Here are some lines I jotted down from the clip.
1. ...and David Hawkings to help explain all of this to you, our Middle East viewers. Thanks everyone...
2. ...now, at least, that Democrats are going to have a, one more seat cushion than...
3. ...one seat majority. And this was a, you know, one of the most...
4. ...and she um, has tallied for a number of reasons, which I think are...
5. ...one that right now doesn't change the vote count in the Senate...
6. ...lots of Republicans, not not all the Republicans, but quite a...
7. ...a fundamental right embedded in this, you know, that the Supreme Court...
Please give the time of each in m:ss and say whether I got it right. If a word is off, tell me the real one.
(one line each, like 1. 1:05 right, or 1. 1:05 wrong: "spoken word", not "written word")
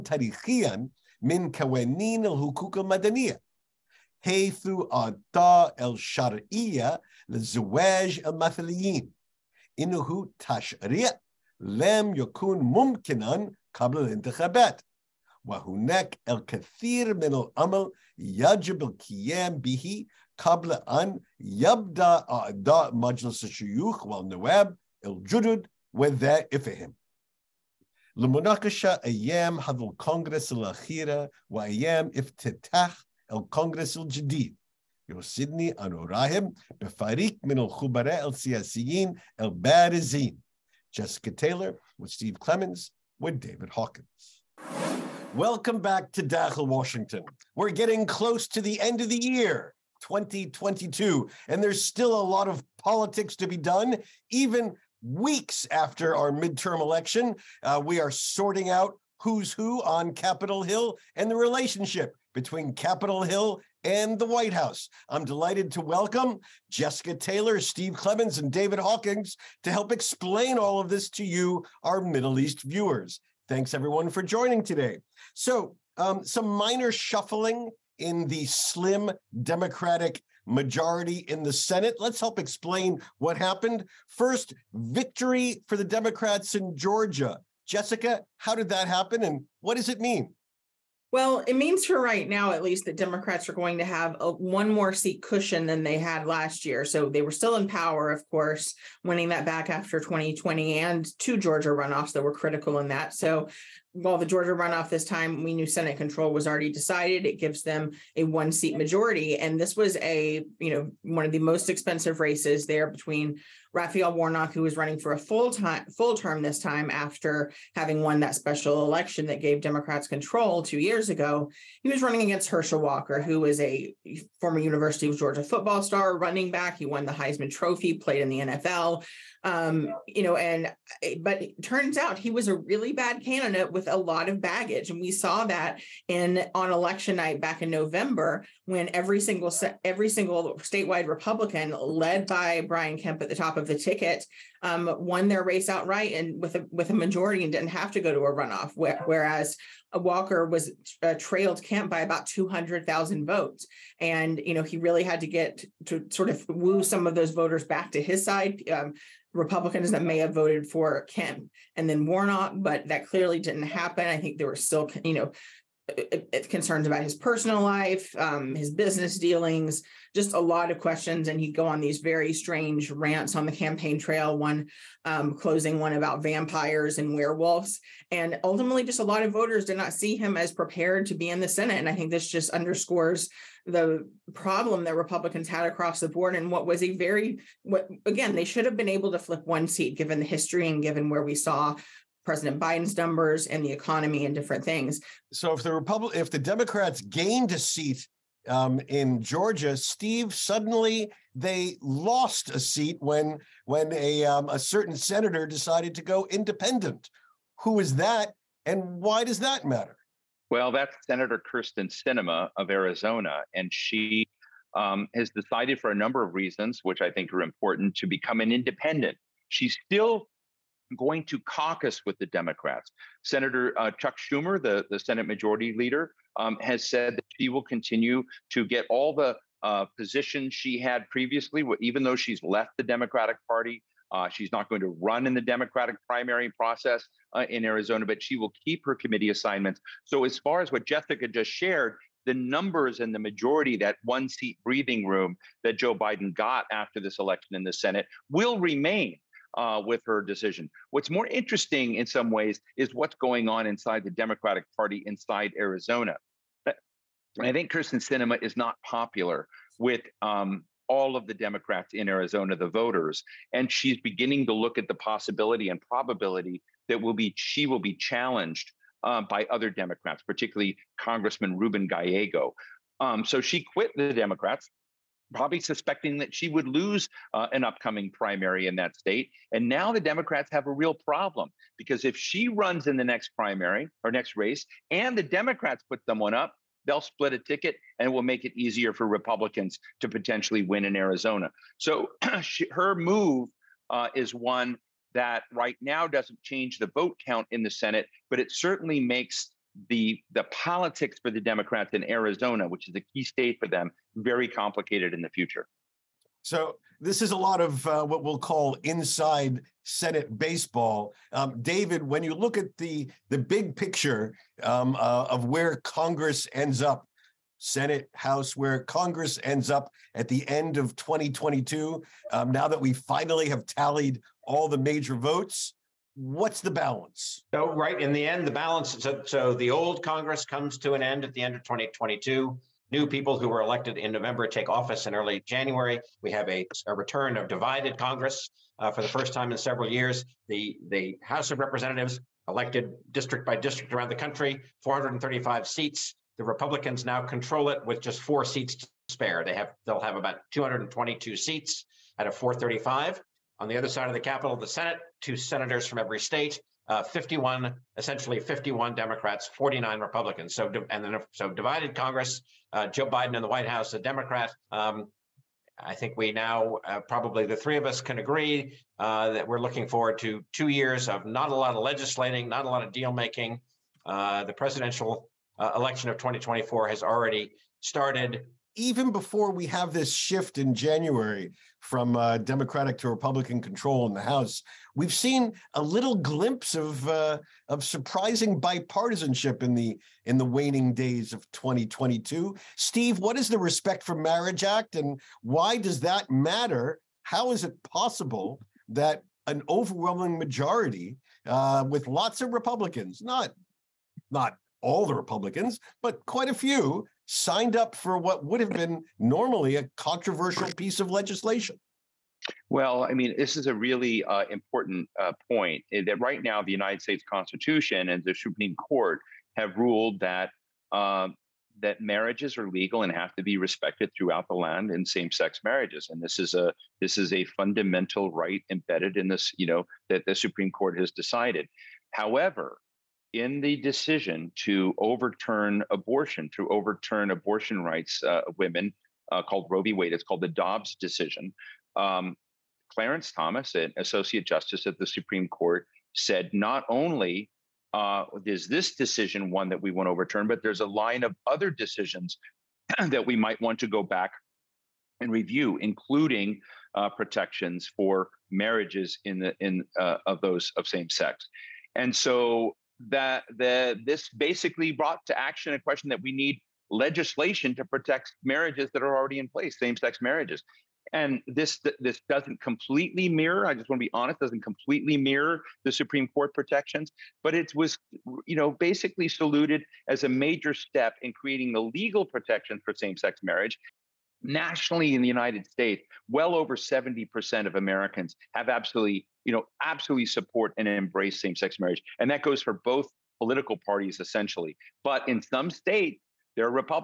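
1. 1:08 right
2. 1:32 right
3. 1:48 right
4. 3:33 wrong: "decided", not "tallied"
5. 4:54 right
6. 6:42 right
7. 7:07 right.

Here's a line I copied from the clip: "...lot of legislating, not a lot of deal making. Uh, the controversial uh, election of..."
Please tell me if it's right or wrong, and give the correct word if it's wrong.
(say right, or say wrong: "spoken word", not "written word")
wrong: "presidential", not "controversial".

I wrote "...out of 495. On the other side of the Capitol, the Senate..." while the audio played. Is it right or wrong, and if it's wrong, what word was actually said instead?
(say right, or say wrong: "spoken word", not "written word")
wrong: "435", not "495".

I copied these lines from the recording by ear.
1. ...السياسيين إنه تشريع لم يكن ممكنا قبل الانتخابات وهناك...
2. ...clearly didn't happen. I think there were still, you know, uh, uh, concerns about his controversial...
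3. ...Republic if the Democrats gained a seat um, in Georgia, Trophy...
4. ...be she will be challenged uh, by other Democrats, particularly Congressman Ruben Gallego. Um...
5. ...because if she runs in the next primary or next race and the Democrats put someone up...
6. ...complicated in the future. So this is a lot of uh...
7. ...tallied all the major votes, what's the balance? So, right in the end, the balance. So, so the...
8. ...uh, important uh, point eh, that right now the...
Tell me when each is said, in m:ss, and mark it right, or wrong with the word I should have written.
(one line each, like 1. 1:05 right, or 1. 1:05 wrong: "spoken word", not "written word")
1. 0:08 wrong: "المثليين", not "السياسيين"
2. 2:43 wrong: "personal", not "controversial"
3. 3:15 wrong: "Steve", not "Trophy"
4. 4:27 right
5. 4:41 right
6. 5:04 right
7. 5:23 right
8. 6:54 right.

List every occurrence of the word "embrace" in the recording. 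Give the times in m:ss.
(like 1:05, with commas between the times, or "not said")
8:10.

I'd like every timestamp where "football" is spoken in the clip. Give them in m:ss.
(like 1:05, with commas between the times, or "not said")
2:05.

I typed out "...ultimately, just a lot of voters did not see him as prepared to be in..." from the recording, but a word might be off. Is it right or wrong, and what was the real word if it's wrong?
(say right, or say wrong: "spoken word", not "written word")
right.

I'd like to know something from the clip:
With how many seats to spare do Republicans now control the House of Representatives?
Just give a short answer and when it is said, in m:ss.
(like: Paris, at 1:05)
four, at 5:48.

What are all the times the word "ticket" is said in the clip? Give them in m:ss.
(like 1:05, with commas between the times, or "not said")
2:23, 4:47.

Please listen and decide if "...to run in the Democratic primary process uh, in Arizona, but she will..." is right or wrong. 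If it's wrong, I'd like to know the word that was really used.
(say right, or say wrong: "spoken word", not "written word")
right.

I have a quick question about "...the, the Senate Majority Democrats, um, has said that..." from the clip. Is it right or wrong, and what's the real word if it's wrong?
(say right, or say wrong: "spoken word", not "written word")
wrong: "Leader", not "Democrats".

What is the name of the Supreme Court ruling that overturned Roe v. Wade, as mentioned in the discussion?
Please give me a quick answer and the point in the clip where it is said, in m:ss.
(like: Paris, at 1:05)
Dobbs decision, at 7:20.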